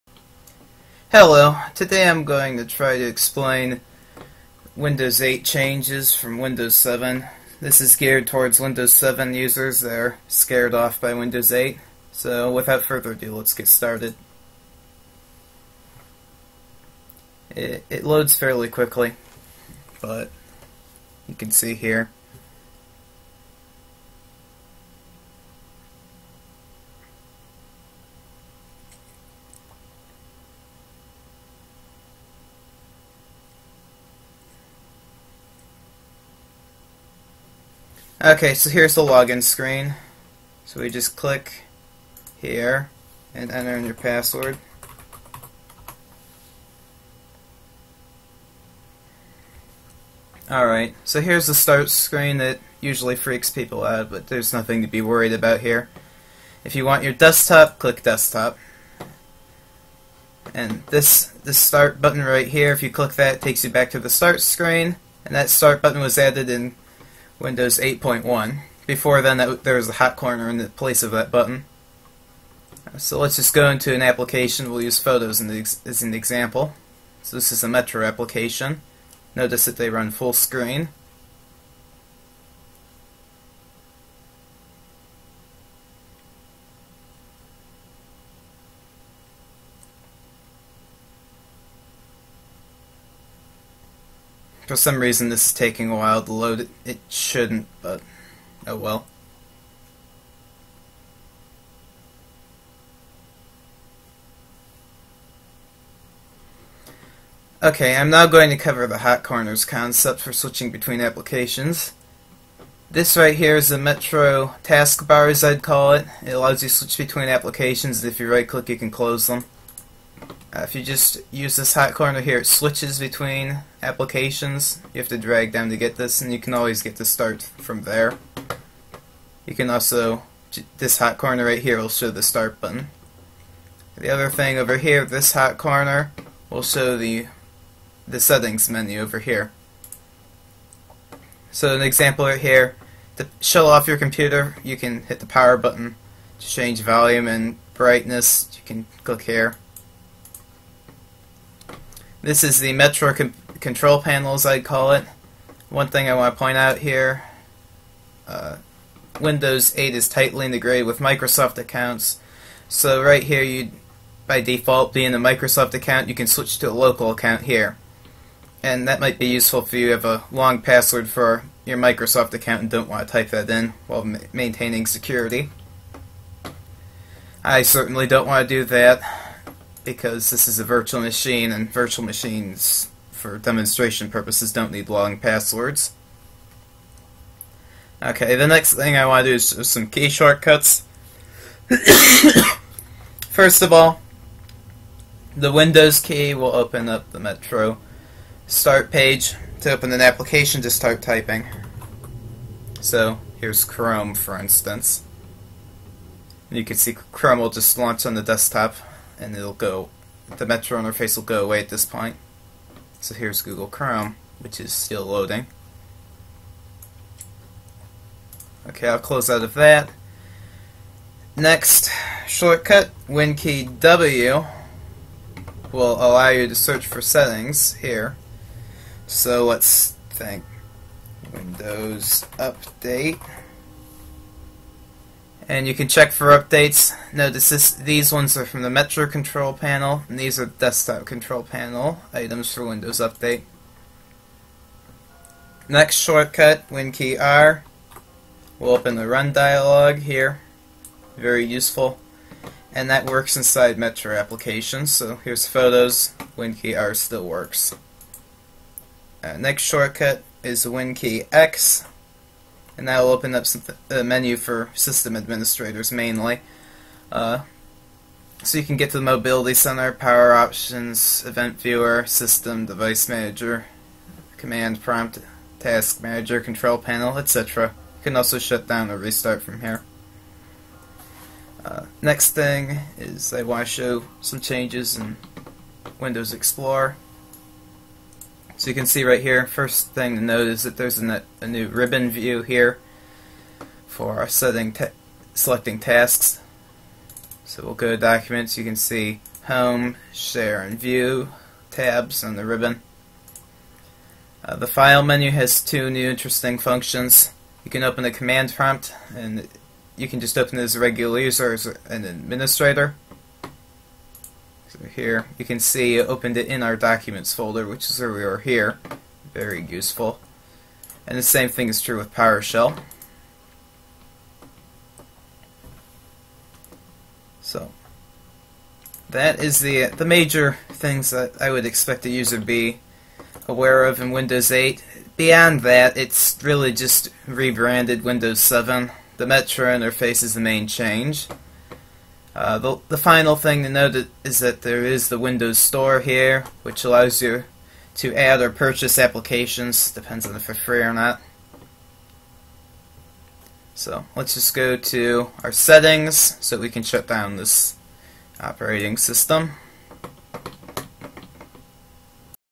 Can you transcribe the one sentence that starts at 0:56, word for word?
If you want your desktop, click desktop.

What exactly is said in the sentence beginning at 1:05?
And that start button was added in Windows 8.1.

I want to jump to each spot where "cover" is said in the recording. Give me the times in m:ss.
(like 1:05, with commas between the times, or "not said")
1:48.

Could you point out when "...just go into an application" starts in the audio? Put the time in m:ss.
1:13.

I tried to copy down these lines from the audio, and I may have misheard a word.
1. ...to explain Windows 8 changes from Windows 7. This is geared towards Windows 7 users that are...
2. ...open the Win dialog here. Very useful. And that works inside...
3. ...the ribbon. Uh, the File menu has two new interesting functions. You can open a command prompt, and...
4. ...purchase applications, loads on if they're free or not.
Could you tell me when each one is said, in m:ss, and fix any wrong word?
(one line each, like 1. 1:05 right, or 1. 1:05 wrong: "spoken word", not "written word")
1. 0:02 right
2. 4:08 wrong: "Run", not "Win"
3. 5:02 right
4. 5:48 wrong: "depends", not "loads".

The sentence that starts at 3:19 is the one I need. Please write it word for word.
To open an application, just start typing.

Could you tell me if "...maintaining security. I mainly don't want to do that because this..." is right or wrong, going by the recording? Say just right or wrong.
wrong.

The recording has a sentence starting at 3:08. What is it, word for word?
Okay, the next thing I want to do is some key shortcuts.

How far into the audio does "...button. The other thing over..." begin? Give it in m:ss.
2:12.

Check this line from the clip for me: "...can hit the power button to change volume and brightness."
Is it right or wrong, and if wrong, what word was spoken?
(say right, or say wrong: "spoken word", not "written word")
right.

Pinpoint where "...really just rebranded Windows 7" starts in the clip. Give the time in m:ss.
5:36.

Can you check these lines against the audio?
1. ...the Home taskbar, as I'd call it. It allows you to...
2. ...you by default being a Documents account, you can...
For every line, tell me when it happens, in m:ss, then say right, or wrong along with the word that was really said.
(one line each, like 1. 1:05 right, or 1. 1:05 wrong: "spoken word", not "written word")
1. 1:53 wrong: "Metro", not "Home"
2. 2:43 wrong: "Microsoft", not "Documents".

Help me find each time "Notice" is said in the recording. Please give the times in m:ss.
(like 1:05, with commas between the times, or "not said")
1:19, 3:57.